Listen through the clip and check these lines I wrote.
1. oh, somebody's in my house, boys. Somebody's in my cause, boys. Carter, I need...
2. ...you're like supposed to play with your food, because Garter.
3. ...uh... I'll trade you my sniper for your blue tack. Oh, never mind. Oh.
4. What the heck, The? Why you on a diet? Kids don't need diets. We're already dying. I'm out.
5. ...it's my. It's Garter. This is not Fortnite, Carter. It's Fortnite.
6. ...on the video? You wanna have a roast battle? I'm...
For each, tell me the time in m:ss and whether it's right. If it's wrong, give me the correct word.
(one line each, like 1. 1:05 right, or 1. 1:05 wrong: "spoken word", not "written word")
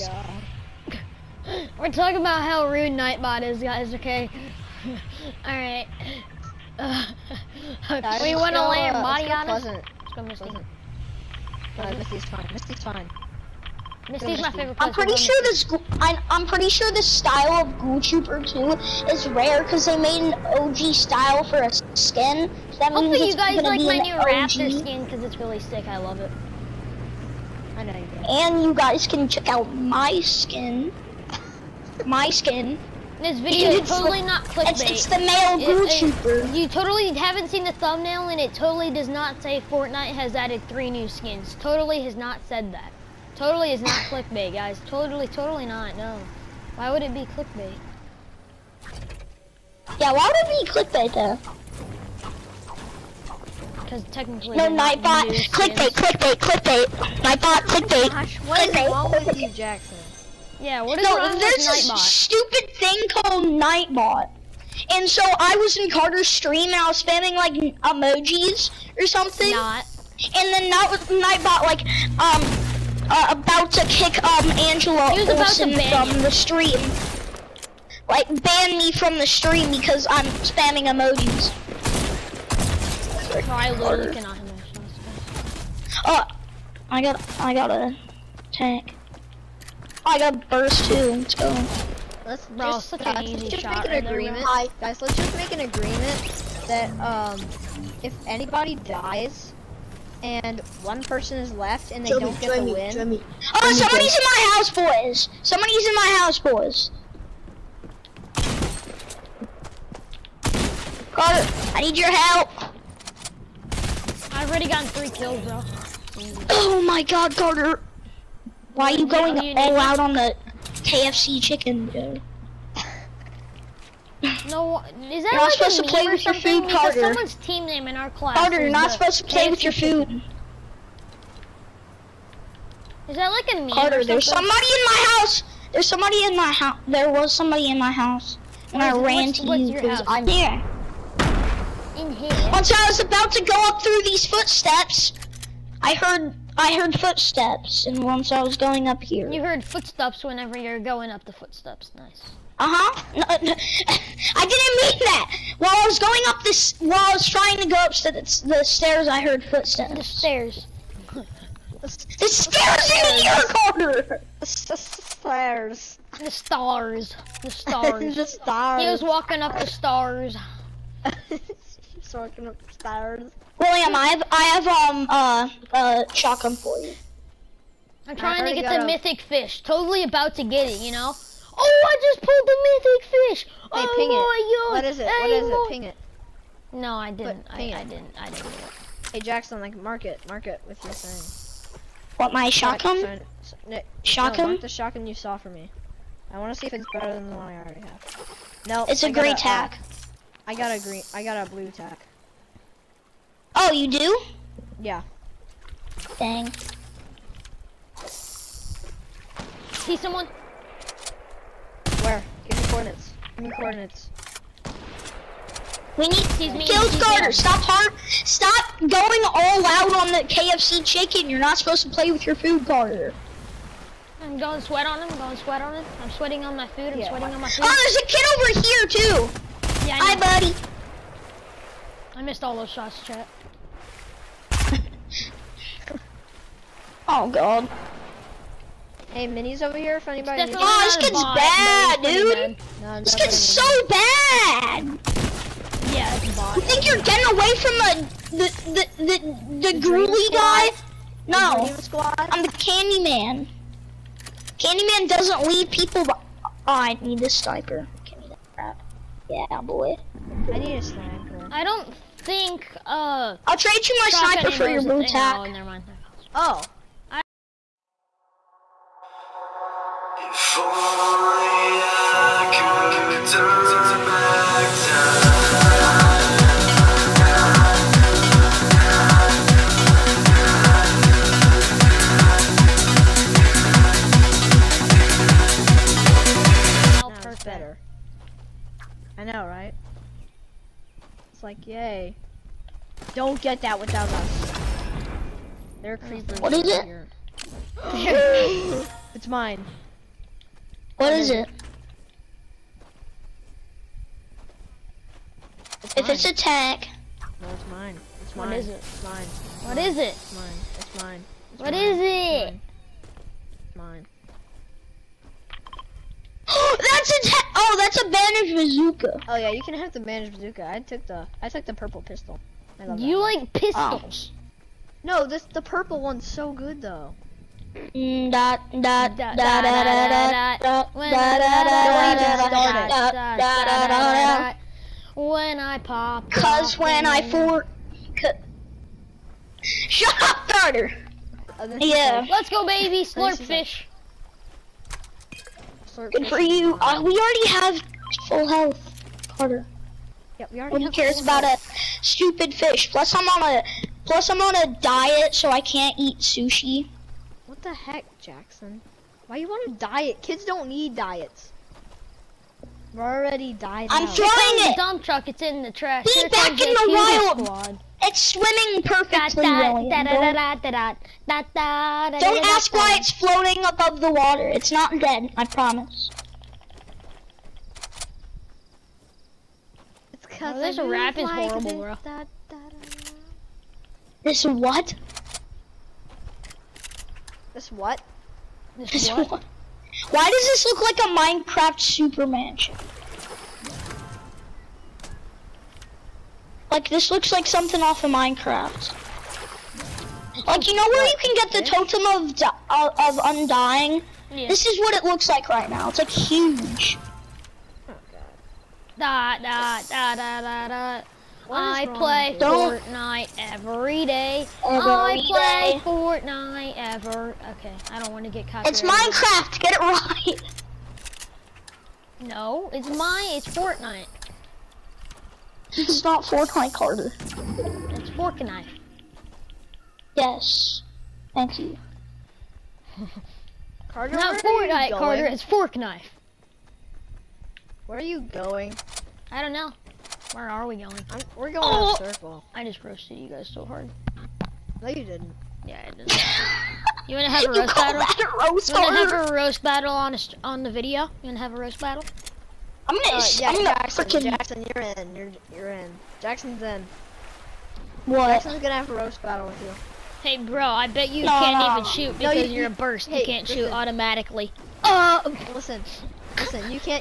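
1. 1:43 wrong: "house", not "cause"
2. 2:05 wrong: "Carter", not "Garter"
3. 4:22 right
4. 5:57 wrong: "Jackson", not "The"
5. 7:02 wrong: "Fortnite", not "Garter"
6. 7:30 right.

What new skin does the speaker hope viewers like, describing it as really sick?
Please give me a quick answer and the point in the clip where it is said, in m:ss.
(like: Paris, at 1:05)
Raptor, at 0:24.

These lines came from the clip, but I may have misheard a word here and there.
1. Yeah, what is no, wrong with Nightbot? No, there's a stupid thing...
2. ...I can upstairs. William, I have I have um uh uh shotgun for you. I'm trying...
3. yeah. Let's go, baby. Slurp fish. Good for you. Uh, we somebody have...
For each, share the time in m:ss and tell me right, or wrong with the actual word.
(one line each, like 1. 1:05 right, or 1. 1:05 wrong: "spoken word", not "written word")
1. 1:00 right
2. 2:52 right
3. 5:41 wrong: "already", not "somebody".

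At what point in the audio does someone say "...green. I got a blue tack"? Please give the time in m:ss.
3:20.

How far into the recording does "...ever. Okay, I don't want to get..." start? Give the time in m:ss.
6:56.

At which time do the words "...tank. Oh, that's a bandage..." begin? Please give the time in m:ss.
5:17.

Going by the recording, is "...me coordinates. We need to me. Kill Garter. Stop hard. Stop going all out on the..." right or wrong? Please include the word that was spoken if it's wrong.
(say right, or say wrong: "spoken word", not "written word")
right.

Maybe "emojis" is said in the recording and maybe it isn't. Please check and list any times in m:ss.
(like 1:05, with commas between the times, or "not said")
1:07, 1:20.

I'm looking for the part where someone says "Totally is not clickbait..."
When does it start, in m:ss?
0:43.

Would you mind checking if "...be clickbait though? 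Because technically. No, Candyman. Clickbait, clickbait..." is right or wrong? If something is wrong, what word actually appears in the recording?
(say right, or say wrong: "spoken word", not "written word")
wrong: "Nightbot", not "Candyman".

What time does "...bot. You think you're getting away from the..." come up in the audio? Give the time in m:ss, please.
4:06.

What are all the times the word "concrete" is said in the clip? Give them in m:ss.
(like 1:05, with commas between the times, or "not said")
not said.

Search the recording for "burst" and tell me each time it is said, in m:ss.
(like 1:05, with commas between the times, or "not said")
1:30, 7:42.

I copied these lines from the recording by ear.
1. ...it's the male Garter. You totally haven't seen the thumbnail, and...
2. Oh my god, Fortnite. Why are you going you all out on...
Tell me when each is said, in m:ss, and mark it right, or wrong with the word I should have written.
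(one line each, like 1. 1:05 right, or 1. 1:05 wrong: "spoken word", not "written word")
1. 0:34 wrong: "YouTuber", not "Garter"
2. 1:56 wrong: "Carter", not "Fortnite".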